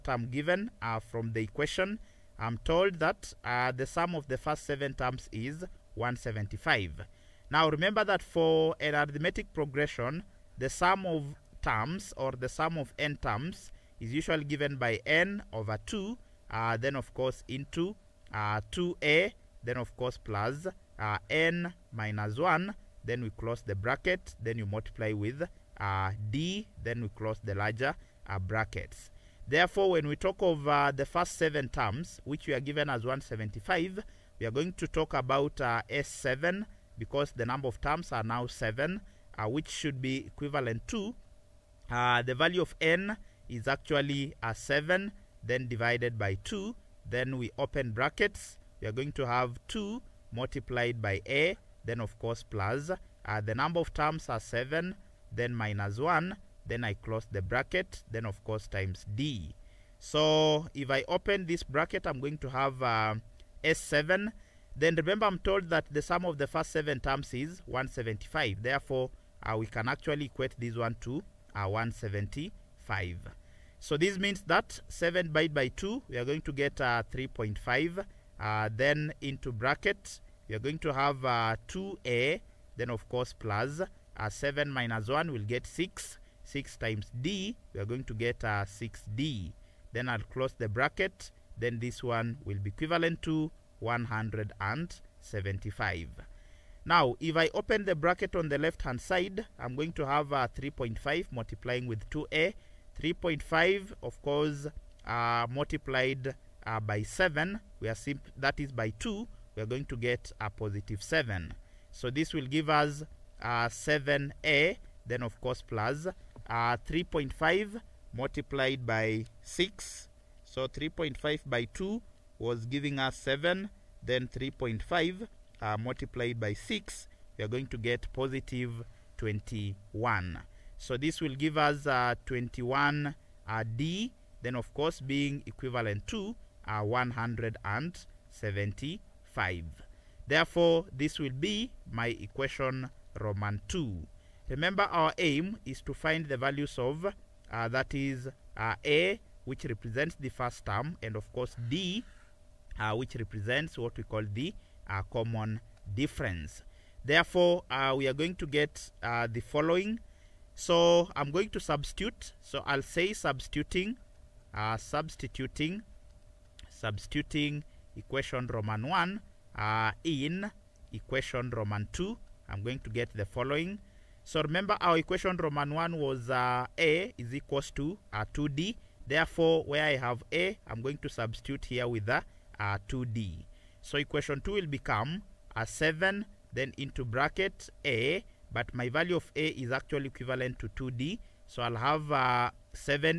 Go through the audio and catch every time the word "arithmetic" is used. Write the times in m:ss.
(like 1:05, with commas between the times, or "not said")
0:08.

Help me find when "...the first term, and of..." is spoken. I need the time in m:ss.
2:30.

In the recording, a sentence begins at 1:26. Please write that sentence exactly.
6 times d, we are going to get 6d.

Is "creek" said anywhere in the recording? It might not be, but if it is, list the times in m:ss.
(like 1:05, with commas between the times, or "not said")
not said.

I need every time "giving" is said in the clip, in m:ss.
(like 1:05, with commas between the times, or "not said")
2:02.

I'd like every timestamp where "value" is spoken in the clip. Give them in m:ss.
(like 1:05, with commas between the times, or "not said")
0:42, 2:26, 3:08.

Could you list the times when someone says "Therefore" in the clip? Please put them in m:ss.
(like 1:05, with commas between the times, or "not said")
0:29, 1:08, 2:20, 2:37, 2:59.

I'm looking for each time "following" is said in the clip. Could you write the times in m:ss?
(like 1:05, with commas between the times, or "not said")
2:39, 2:53.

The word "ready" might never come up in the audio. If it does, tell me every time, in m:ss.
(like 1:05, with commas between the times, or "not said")
not said.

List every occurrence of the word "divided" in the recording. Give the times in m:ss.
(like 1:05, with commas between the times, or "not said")
0:45, 1:15.